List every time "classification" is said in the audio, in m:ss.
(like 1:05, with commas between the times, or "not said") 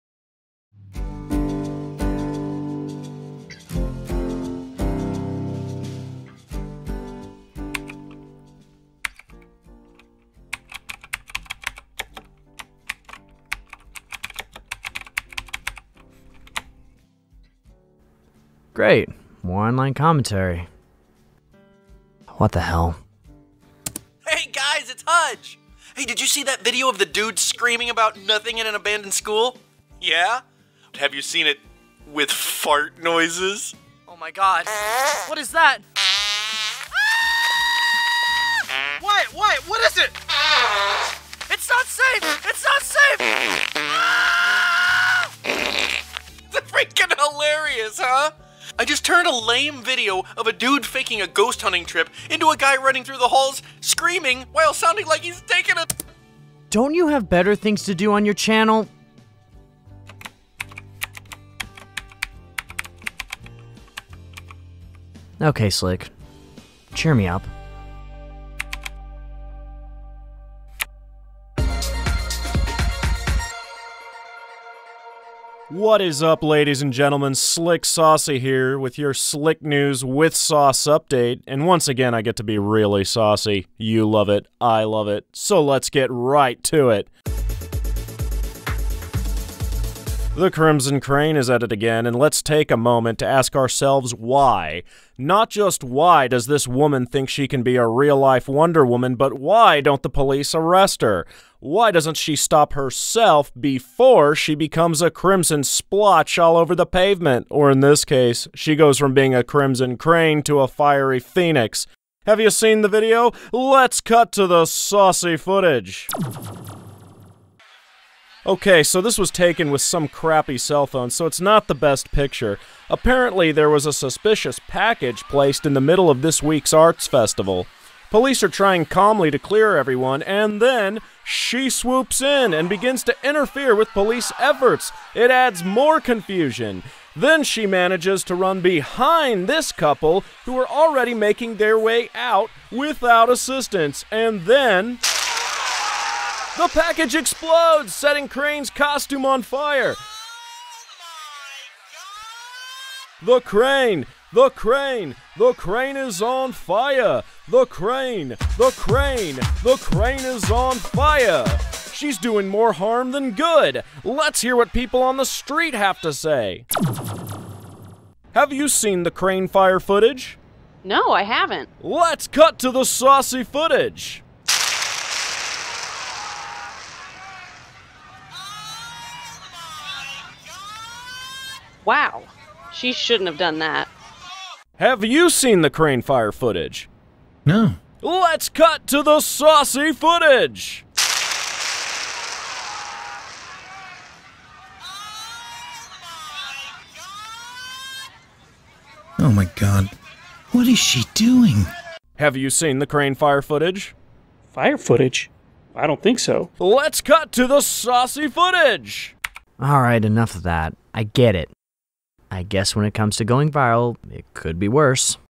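not said.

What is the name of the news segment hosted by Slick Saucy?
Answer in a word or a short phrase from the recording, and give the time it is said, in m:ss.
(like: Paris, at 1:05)
Slick News with Sauce, at 1:19.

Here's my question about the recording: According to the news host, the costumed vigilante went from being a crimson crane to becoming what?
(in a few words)
A fiery phoenix.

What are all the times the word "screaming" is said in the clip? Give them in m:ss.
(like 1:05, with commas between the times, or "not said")
0:27, 0:53.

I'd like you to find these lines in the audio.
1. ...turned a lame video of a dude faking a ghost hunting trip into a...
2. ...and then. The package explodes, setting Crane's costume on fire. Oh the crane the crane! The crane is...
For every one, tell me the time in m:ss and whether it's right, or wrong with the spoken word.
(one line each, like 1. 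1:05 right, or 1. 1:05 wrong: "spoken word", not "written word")
1. 0:49 right
2. 2:24 right.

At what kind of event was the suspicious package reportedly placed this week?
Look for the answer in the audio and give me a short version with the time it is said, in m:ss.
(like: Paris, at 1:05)
Arts festival, at 2:06.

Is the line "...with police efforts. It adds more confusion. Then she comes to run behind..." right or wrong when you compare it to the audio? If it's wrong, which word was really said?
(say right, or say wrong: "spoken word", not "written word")
wrong: "manages", not "comes".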